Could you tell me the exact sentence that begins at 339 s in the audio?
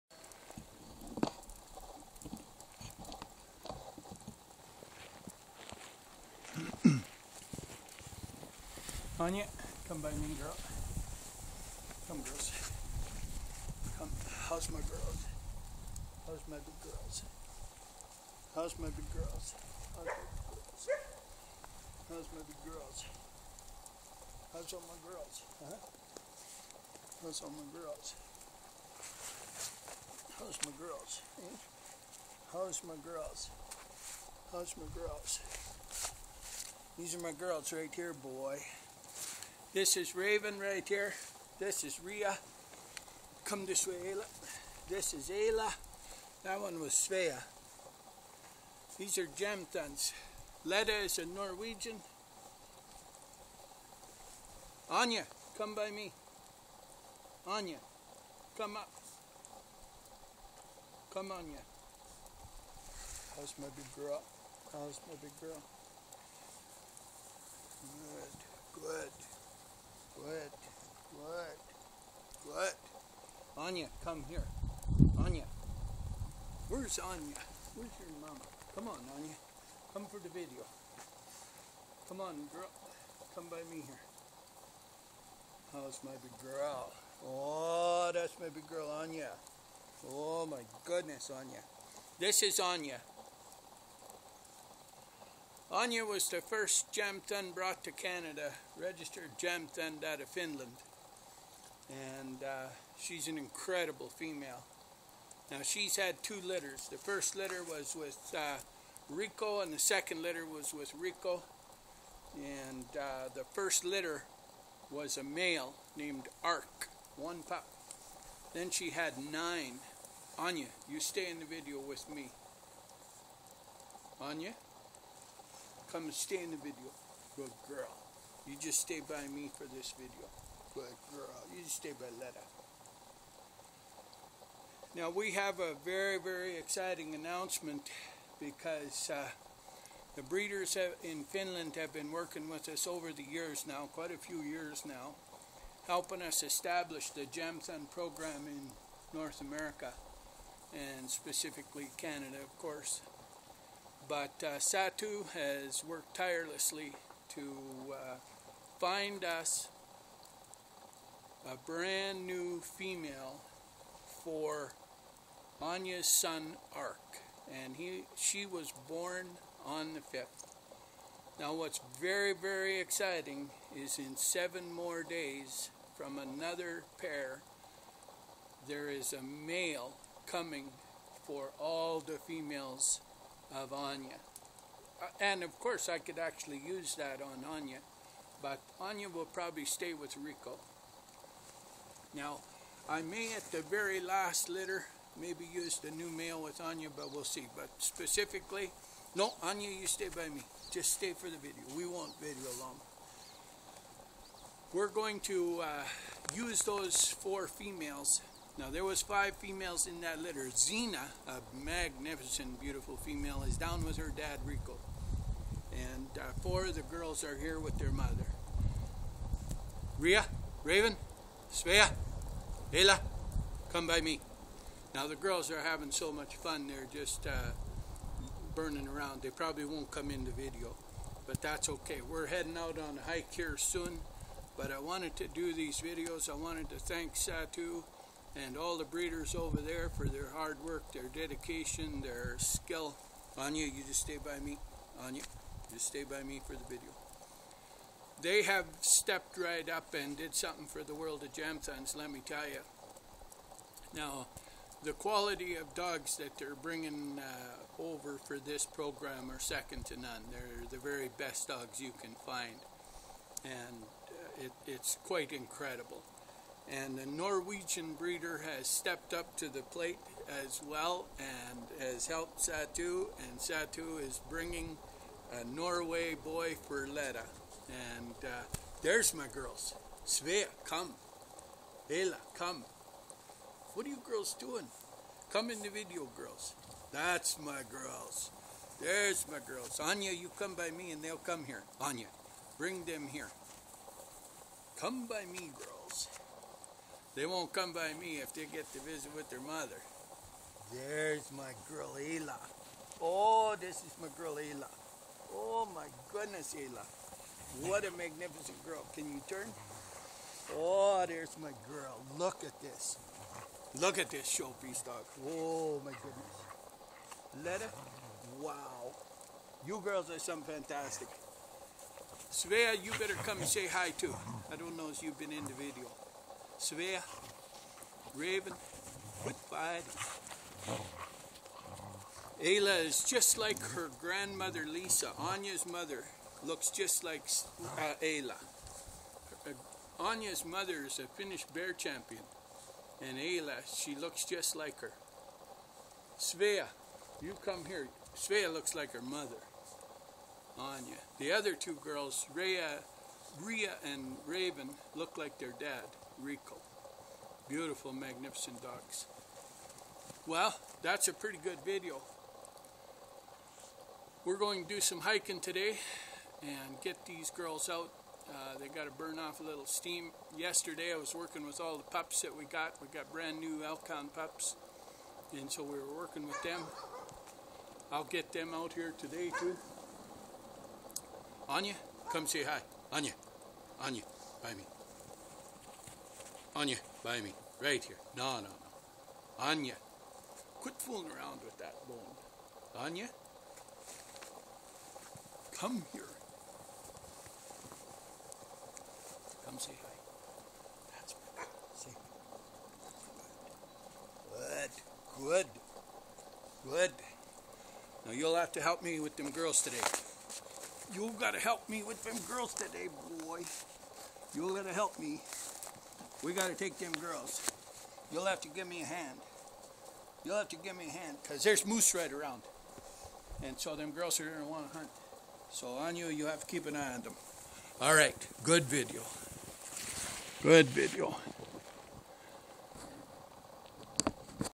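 Uh, Anya's mother is a Finnish bear champion, and Ayla, she looks just like her.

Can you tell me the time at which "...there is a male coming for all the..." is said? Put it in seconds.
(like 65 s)
178 s.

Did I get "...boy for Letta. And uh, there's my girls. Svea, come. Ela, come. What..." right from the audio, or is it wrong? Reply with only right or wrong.
right.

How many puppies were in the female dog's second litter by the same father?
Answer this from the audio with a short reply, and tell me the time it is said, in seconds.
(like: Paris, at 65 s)
9, at 119 s.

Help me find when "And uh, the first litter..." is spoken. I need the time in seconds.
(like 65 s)
112 s.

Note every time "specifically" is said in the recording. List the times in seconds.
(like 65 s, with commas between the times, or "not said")
151 s, 197 s.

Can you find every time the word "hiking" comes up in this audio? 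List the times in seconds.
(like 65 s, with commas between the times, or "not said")
365 s.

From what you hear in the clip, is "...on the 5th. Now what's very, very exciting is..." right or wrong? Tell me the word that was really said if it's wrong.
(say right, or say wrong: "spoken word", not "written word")
right.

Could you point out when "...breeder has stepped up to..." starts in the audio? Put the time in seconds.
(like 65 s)
267 s.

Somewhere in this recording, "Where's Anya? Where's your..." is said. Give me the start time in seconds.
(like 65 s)
76 s.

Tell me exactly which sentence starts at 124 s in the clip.
Anya, come and stay in the video.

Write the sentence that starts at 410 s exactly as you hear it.
You've got to help me with them girls today, boy.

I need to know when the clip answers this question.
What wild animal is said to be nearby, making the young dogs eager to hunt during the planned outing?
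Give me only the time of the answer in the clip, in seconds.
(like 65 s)
421 s.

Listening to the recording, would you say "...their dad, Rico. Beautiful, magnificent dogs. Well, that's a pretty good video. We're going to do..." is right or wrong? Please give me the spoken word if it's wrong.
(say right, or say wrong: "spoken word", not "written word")
right.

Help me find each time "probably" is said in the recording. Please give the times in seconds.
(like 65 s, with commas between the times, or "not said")
189 s, 229 s.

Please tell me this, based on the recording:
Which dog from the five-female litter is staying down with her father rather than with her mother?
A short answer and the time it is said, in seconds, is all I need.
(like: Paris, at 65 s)
Zena, at 210 s.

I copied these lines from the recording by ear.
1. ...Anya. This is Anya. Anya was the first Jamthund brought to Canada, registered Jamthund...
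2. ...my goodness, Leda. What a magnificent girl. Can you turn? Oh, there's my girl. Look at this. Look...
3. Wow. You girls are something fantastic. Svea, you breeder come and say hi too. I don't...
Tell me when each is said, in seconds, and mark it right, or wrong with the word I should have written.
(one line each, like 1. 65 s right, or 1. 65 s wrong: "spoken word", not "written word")
1. 91 s right
2. 305 s wrong: "Ela", not "Leda"
3. 318 s wrong: "better", not "breeder".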